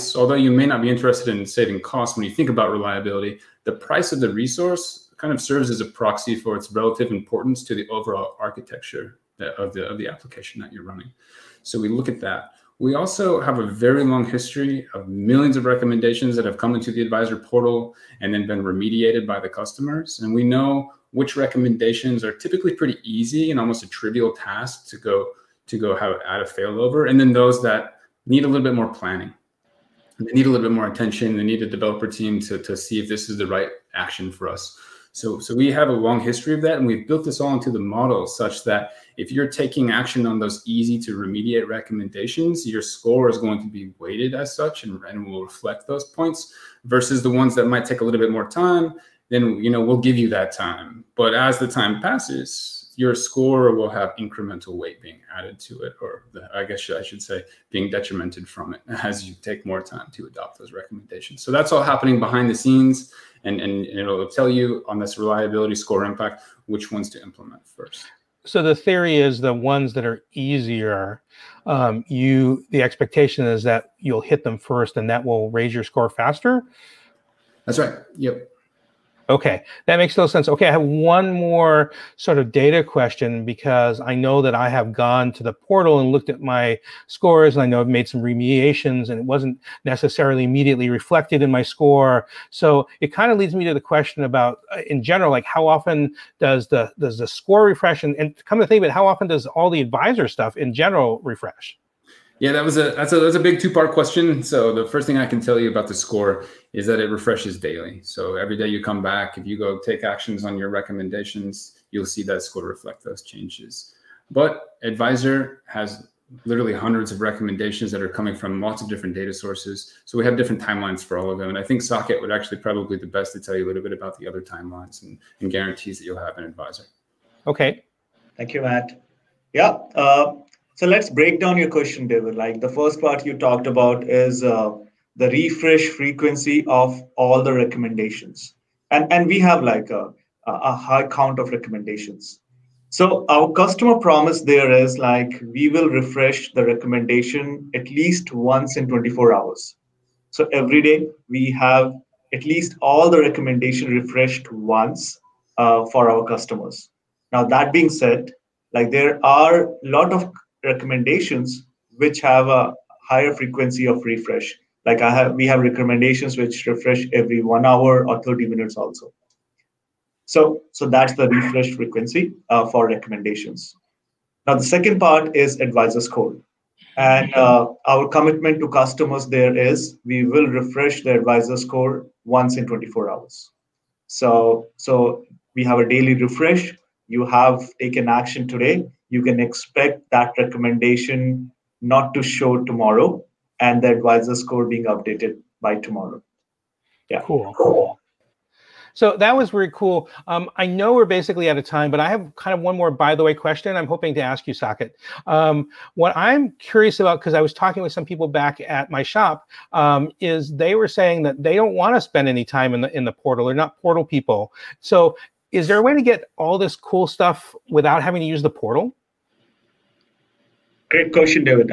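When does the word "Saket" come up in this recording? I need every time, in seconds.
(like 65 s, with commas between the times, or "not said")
121 s, 204 s.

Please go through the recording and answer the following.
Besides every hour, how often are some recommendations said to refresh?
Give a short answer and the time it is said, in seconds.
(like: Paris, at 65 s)
30 minutes, at 168 s.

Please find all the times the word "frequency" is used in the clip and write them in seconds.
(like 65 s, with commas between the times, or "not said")
135 s, 163 s, 171 s.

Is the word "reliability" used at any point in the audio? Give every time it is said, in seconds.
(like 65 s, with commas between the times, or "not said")
2 s, 65 s.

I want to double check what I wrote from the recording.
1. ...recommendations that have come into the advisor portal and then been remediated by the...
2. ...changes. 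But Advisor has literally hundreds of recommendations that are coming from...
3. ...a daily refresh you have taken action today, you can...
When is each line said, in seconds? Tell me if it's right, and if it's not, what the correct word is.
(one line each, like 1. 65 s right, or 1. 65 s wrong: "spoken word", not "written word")
1. 15 s right
2. 113 s right
3. 185 s right.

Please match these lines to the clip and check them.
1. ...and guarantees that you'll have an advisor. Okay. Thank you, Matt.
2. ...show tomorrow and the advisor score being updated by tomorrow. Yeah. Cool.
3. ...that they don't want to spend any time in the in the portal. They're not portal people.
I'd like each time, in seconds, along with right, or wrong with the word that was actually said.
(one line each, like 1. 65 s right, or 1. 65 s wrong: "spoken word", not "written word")
1. 125 s right
2. 192 s right
3. 211 s right.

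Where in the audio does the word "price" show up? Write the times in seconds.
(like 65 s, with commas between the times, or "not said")
3 s.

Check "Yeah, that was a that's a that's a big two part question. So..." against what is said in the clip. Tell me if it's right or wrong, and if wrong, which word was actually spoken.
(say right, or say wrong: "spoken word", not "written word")
right.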